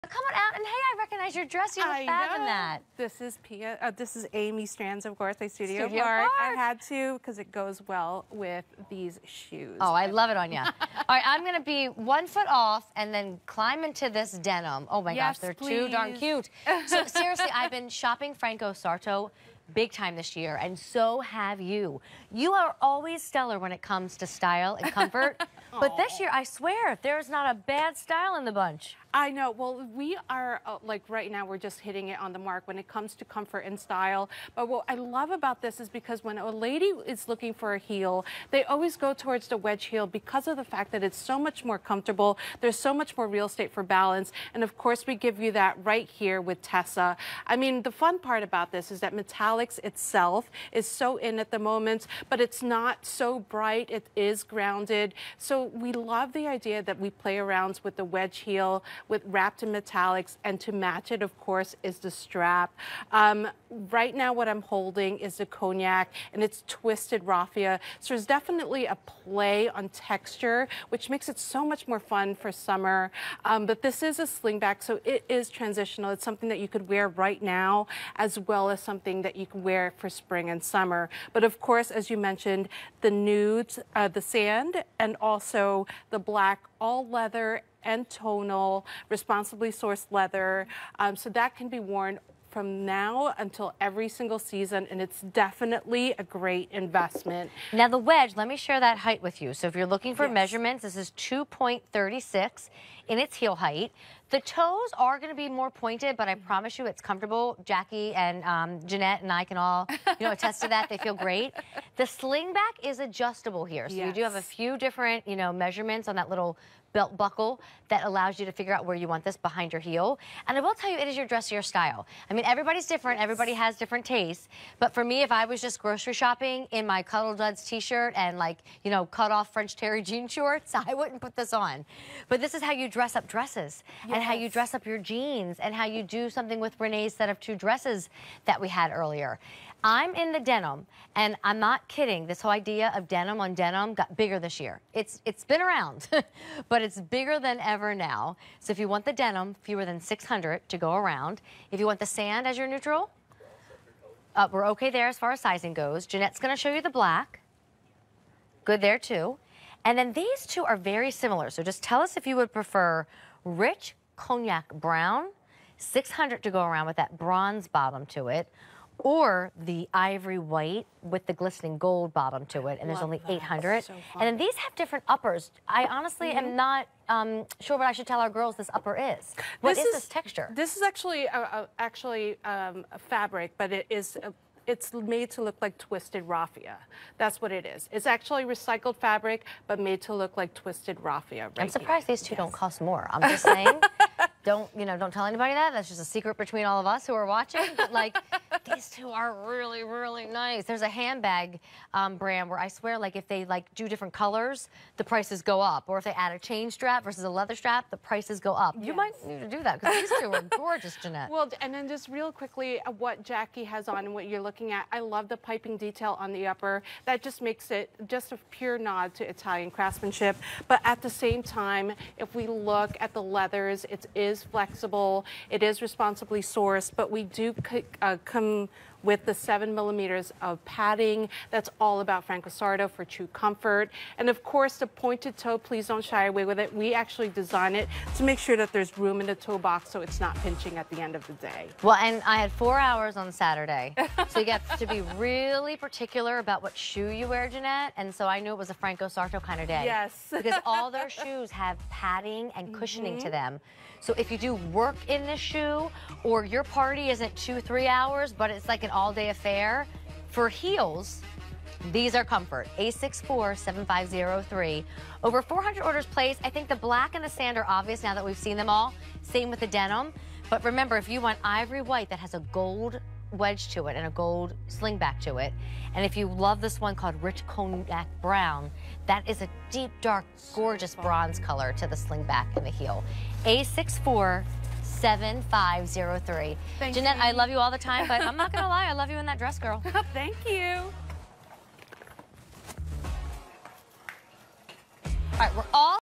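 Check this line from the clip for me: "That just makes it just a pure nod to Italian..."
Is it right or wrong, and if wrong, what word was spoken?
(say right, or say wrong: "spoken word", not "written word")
right.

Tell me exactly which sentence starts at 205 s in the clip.
Or if they add a chain strap versus a leather strap, the prices go up.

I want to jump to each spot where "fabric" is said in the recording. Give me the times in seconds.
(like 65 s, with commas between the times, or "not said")
183 s, 189 s.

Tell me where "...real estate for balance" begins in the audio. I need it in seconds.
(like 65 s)
43 s.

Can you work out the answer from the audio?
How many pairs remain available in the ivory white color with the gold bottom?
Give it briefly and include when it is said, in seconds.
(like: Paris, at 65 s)
800, at 173 s.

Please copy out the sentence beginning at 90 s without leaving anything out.
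Um, so that can be worn from now until every single season, and it's definitely a great investment.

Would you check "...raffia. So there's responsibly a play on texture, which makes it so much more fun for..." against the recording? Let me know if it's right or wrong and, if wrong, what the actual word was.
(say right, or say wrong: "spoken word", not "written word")
wrong: "definitely", not "responsibly".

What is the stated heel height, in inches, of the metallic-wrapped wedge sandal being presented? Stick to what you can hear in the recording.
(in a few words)
2.36.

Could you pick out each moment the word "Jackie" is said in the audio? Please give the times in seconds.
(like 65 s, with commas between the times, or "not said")
107 s, 213 s.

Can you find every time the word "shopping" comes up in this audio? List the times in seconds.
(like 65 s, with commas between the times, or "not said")
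17 s, 126 s.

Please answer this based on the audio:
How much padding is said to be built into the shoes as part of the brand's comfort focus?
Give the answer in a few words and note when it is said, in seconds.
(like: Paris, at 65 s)
7 millimeters, at 229 s.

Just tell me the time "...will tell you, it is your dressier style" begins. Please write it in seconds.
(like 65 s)
120 s.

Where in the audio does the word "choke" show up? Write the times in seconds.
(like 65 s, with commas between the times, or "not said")
not said.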